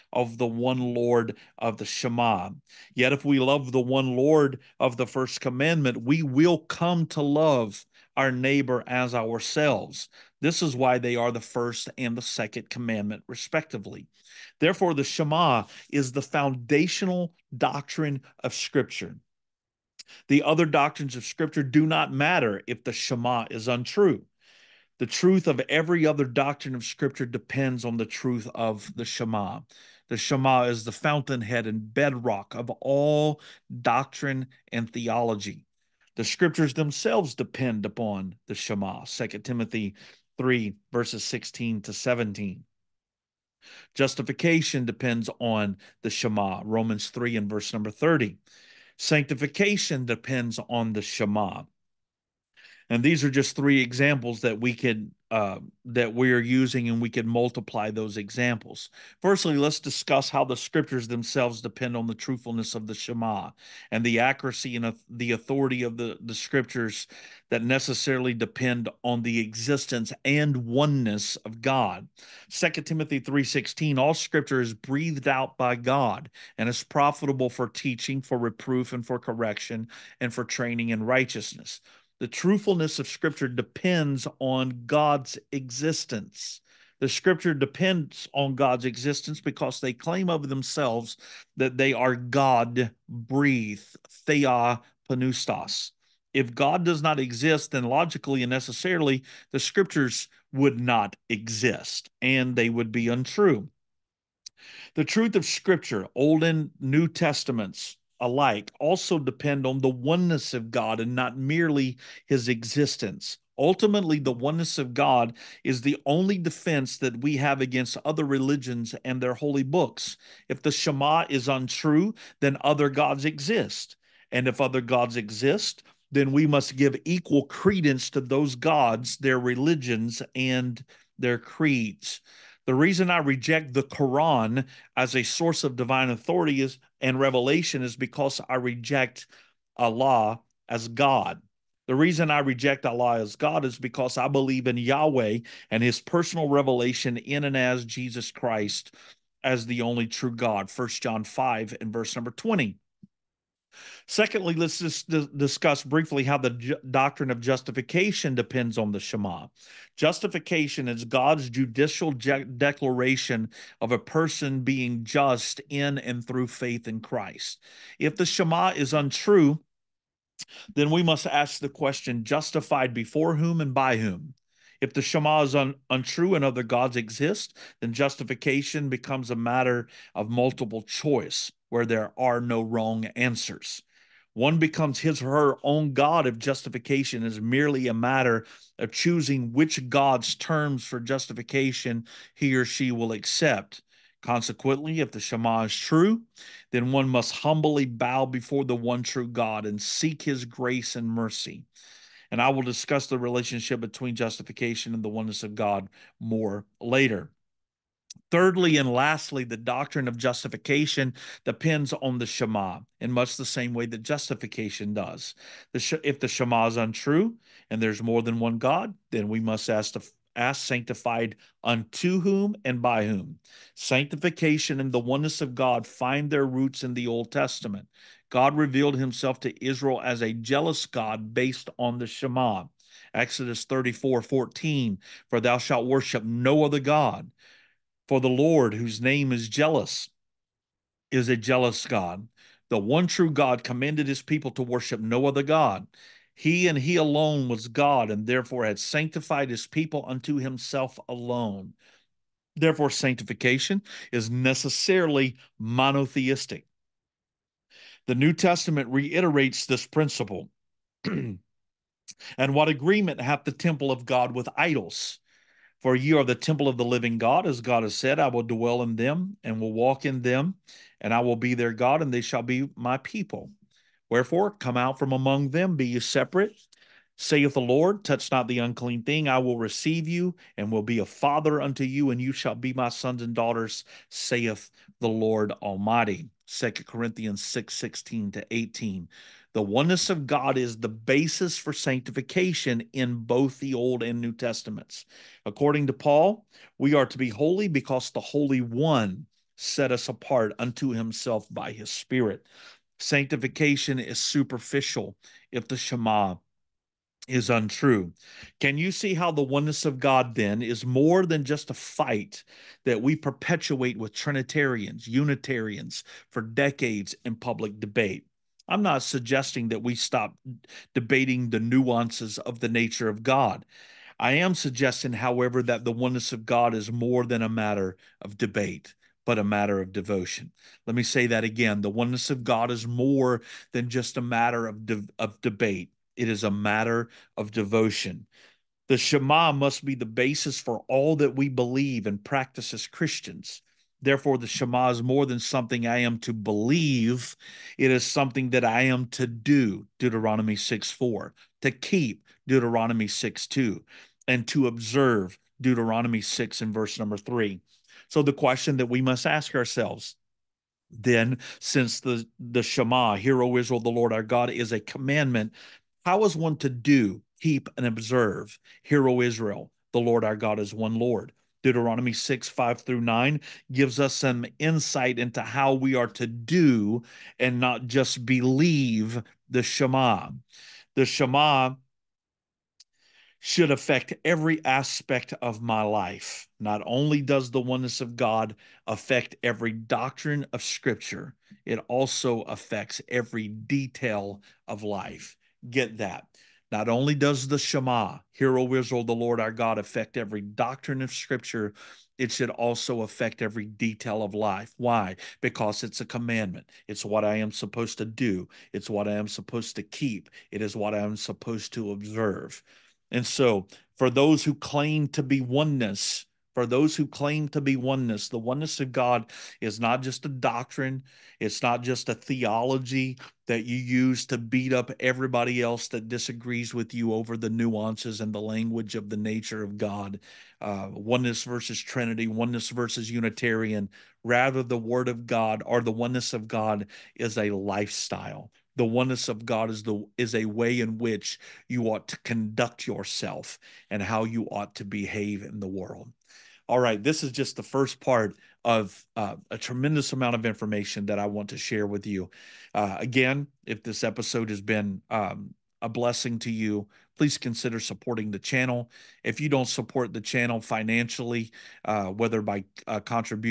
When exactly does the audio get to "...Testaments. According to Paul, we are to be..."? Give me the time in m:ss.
4:54.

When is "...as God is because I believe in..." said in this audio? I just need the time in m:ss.
2:23.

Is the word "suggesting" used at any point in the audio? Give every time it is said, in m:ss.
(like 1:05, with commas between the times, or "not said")
5:19, 5:24.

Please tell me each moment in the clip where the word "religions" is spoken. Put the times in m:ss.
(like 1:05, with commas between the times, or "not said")
1:58, 2:09.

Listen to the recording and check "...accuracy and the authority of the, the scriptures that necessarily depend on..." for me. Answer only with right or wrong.
right.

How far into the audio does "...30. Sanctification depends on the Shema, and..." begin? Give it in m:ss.
0:47.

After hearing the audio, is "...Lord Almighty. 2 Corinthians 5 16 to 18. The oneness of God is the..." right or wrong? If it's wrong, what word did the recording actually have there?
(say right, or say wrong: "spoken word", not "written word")
wrong: "6", not "5".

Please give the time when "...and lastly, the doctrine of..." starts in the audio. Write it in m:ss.
3:28.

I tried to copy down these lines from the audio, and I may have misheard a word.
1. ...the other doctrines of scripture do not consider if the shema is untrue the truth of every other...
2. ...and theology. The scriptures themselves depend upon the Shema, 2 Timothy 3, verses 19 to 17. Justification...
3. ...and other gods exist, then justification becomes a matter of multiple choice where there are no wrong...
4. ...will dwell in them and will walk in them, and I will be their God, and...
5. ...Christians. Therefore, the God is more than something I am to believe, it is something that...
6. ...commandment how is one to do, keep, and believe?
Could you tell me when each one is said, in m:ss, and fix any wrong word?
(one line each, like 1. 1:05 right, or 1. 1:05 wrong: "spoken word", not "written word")
1. 0:20 wrong: "matter", not "consider"
2. 0:34 wrong: "16", not "19"
3. 2:56 right
4. 4:28 right
5. 5:42 wrong: "Shema", not "God"
6. 6:04 wrong: "observe", not "believe".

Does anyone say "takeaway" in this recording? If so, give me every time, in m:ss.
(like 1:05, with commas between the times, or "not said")
not said.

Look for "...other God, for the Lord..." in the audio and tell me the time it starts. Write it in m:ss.
3:56.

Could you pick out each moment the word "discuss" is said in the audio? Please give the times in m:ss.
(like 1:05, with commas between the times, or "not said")
0:59, 2:35, 3:22.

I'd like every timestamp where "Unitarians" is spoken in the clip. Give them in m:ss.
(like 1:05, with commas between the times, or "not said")
5:15, 7:13.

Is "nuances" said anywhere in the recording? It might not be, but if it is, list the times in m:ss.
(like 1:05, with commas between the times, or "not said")
5:21, 7:07.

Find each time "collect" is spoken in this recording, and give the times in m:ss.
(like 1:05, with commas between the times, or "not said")
not said.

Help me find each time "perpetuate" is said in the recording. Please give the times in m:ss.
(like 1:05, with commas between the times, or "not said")
5:13.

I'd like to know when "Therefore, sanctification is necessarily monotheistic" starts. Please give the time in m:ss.
4:12.